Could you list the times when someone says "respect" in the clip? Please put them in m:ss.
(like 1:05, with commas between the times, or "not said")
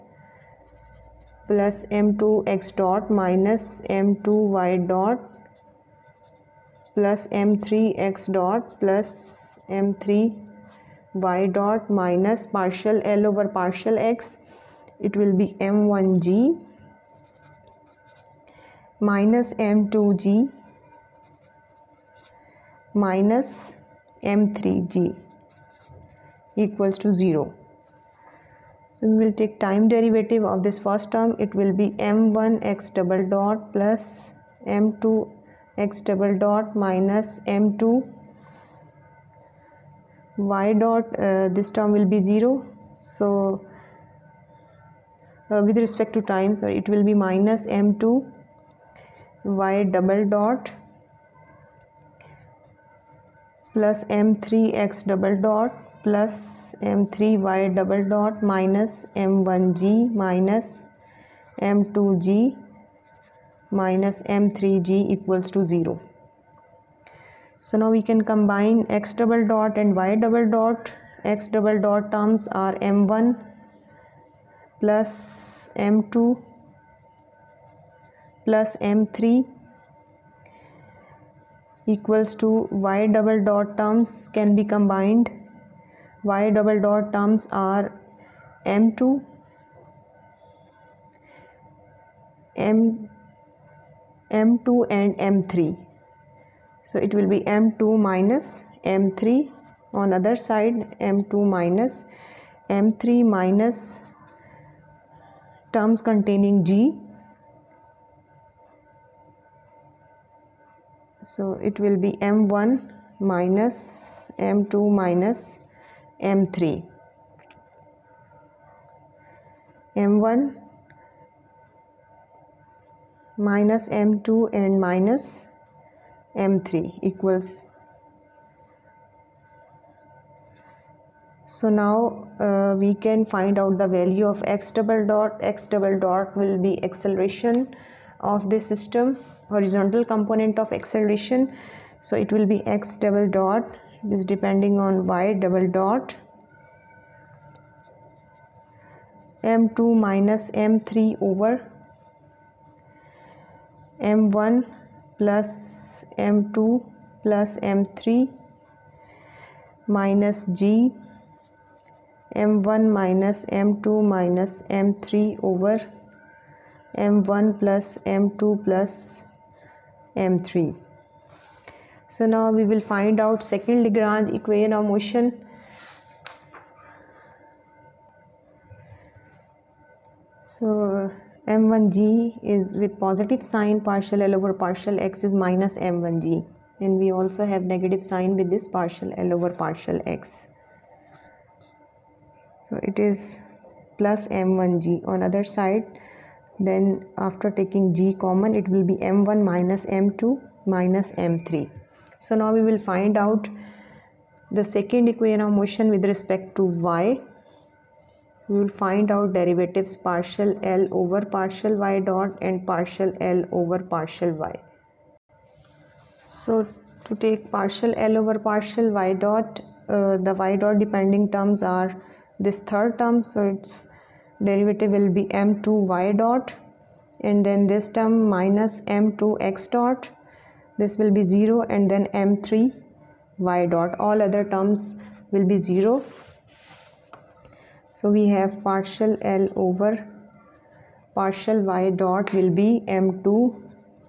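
0:45, 3:26.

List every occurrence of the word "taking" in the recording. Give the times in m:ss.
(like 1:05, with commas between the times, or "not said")
3:17.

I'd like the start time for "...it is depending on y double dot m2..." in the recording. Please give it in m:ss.
2:24.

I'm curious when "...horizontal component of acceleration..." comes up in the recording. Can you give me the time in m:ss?
2:19.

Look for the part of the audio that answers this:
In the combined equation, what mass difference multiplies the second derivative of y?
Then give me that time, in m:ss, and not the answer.
1:37.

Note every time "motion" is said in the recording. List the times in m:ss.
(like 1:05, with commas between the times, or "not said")
2:54, 3:25.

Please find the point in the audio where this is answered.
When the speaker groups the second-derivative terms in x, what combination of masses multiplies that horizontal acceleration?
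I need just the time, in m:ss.
1:12.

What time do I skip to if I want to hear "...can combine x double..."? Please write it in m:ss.
1:08.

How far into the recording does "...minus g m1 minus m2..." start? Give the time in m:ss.
2:39.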